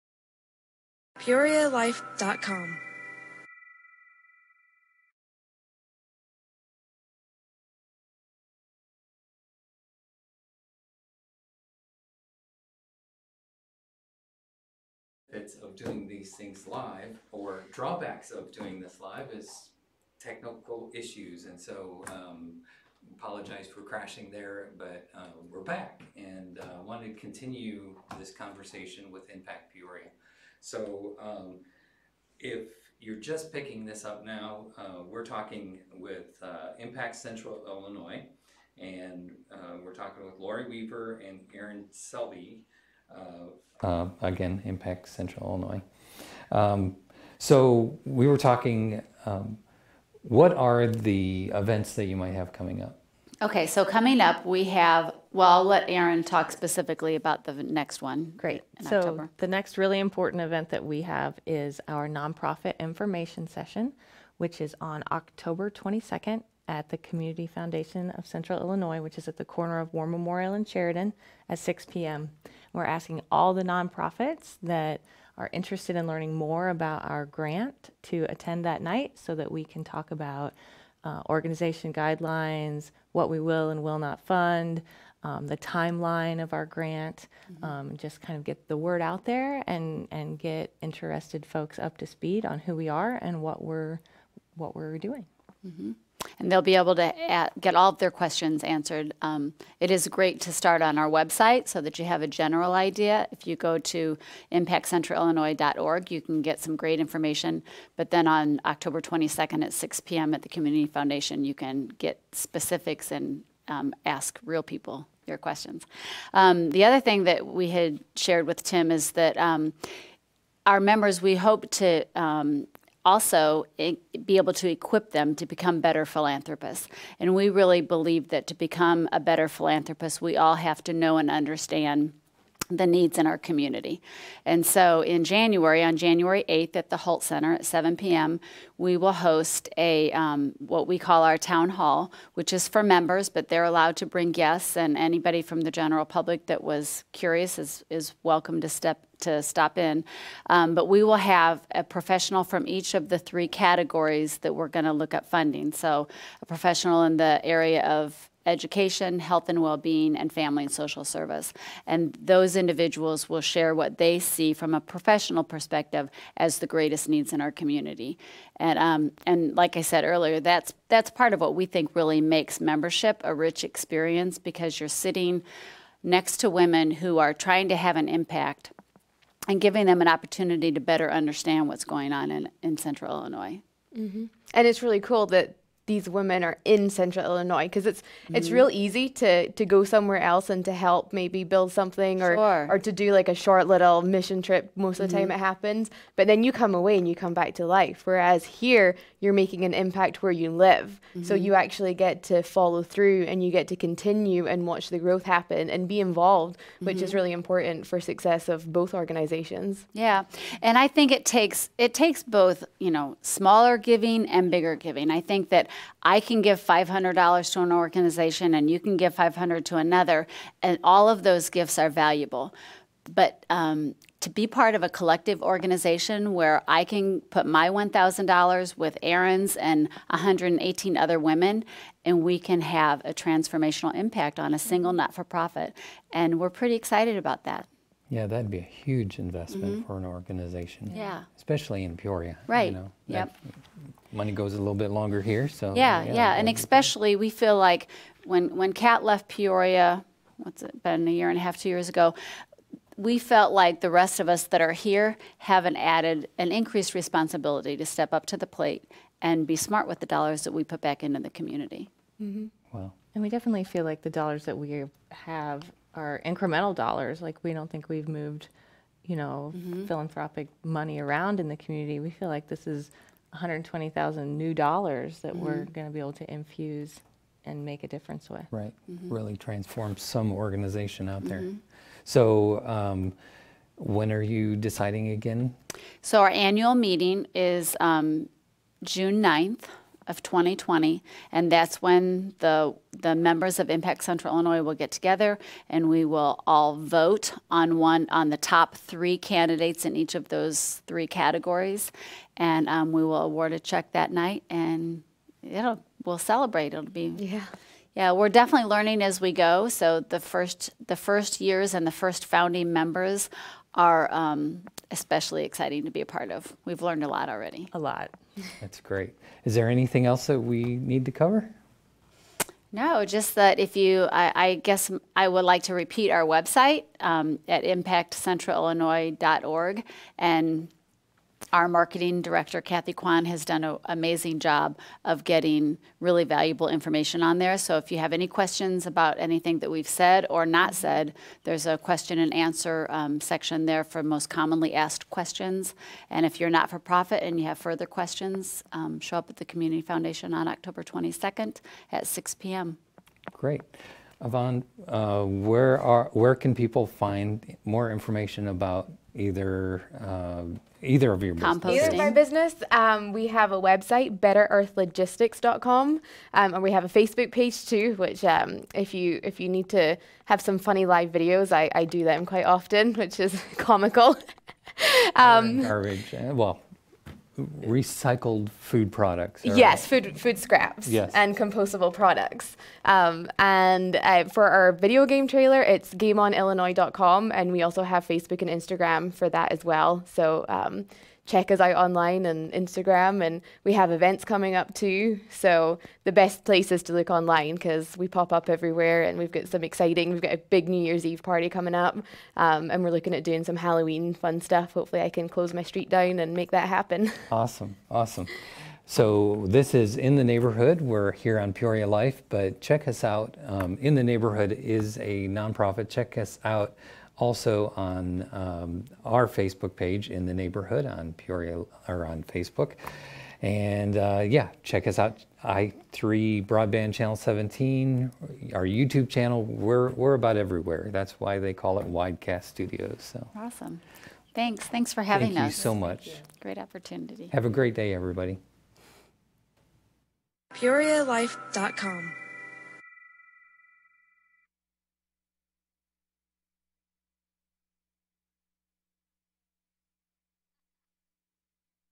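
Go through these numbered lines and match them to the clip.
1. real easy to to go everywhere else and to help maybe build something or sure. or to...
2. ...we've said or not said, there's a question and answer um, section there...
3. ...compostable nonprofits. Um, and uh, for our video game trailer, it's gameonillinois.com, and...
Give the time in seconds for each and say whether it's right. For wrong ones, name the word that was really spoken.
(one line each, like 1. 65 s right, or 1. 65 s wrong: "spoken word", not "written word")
1. 188 s wrong: "somewhere", not "everywhere"
2. 339 s right
3. 381 s wrong: "products", not "nonprofits".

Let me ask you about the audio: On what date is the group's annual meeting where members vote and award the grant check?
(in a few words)
June 9th, 2020.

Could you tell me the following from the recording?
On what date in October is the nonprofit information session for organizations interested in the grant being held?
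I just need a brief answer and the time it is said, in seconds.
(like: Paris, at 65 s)
October 22nd, at 65 s.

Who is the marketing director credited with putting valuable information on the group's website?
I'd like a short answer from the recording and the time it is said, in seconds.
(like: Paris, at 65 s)
Kathy Kwan, at 332 s.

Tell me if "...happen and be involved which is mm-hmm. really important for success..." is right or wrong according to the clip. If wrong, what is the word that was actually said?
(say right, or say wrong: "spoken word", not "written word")
right.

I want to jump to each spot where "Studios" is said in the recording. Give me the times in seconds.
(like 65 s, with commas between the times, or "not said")
432 s.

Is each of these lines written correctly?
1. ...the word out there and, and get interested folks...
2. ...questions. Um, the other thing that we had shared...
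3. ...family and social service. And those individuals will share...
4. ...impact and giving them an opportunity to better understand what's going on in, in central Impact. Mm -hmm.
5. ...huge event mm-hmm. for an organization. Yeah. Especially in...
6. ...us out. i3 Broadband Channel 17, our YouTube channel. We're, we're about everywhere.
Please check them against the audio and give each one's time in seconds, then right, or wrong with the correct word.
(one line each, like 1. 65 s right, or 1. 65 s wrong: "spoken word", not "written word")
1. 88 s right
2. 115 s right
3. 160 s right
4. 178 s wrong: "Illinois", not "Impact"
5. 238 s wrong: "investment", not "event"
6. 424 s right.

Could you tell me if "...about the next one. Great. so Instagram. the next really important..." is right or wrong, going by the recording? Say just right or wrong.
wrong.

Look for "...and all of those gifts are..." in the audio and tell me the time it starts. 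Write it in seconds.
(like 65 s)
220 s.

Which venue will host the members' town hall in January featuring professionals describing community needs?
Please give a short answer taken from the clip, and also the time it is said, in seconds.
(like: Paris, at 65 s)
the Holt Center, at 136 s.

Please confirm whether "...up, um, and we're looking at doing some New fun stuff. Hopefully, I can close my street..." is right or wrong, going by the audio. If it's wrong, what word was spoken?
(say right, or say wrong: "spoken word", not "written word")
wrong: "Halloween", not "New".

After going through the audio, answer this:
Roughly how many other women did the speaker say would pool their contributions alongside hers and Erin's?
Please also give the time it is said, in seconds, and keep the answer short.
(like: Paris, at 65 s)
118, at 230 s.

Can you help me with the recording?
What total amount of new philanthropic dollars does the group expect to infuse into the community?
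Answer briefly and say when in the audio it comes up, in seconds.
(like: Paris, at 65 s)
120,000, at 273 s.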